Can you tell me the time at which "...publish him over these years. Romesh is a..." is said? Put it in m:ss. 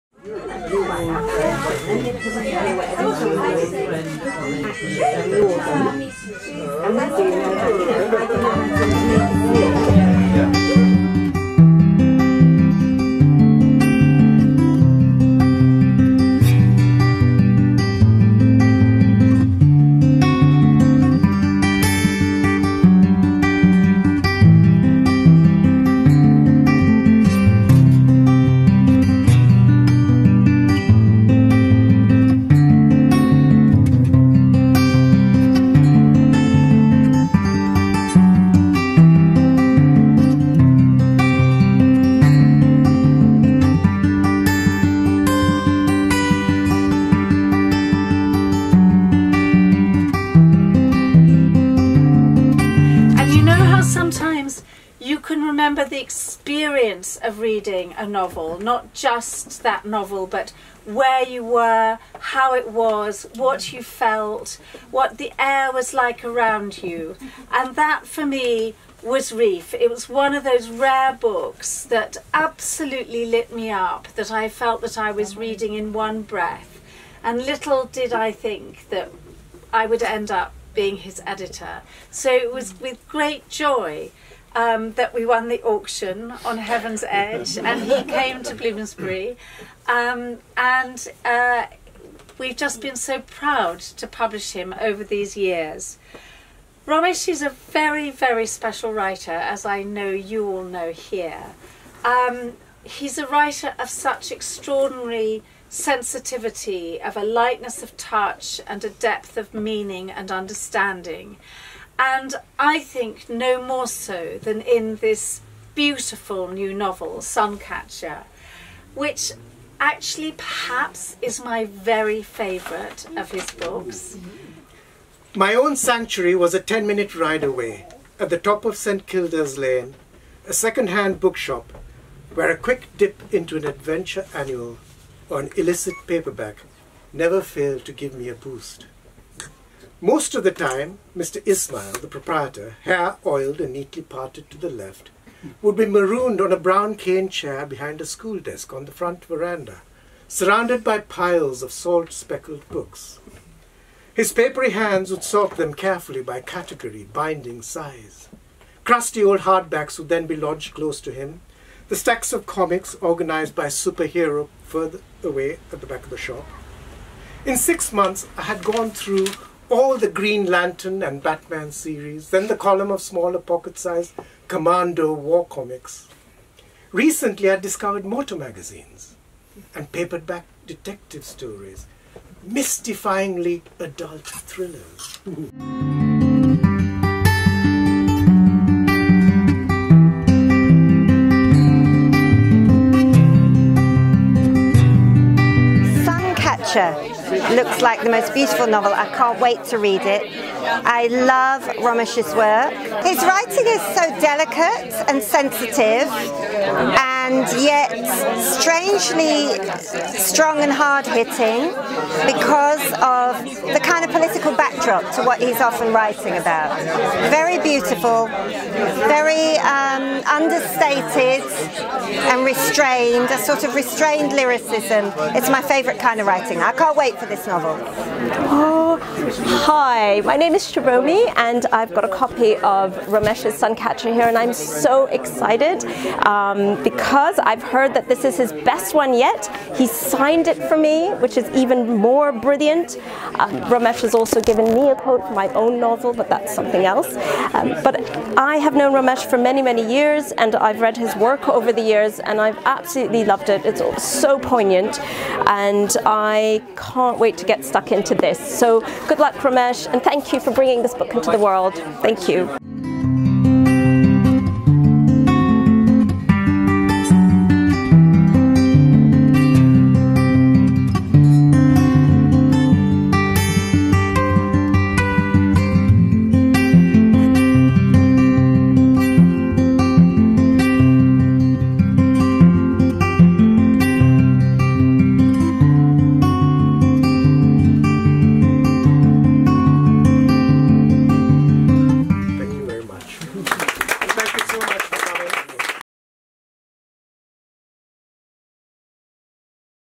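1:34.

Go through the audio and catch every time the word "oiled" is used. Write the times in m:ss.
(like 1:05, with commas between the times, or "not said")
2:23.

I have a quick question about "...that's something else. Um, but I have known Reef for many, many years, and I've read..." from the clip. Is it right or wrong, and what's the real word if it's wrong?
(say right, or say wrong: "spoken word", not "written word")
wrong: "Romesh", not "Reef".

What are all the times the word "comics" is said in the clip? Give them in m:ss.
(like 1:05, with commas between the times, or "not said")
2:42, 2:55.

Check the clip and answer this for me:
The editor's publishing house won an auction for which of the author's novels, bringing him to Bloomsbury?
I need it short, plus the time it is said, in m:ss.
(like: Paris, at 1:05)
Heaven's Edge, at 1:26.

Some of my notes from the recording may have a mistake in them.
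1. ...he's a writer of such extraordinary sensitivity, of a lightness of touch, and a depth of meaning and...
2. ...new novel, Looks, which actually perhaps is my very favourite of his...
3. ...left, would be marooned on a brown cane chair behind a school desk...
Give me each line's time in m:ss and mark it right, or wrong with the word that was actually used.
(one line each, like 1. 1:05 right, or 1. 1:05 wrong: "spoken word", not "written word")
1. 1:42 right
2. 1:56 wrong: "Suncatcher", not "Looks"
3. 2:24 right.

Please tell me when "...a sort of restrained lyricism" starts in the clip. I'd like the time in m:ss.
3:43.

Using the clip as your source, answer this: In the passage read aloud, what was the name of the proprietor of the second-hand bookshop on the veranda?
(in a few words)
Mr. Ismail.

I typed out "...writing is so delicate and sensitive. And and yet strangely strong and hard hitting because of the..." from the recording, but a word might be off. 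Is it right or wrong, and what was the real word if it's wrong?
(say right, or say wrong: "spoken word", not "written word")
right.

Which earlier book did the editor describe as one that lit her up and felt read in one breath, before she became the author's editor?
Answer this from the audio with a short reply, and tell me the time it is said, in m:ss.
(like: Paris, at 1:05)
Reef, at 1:09.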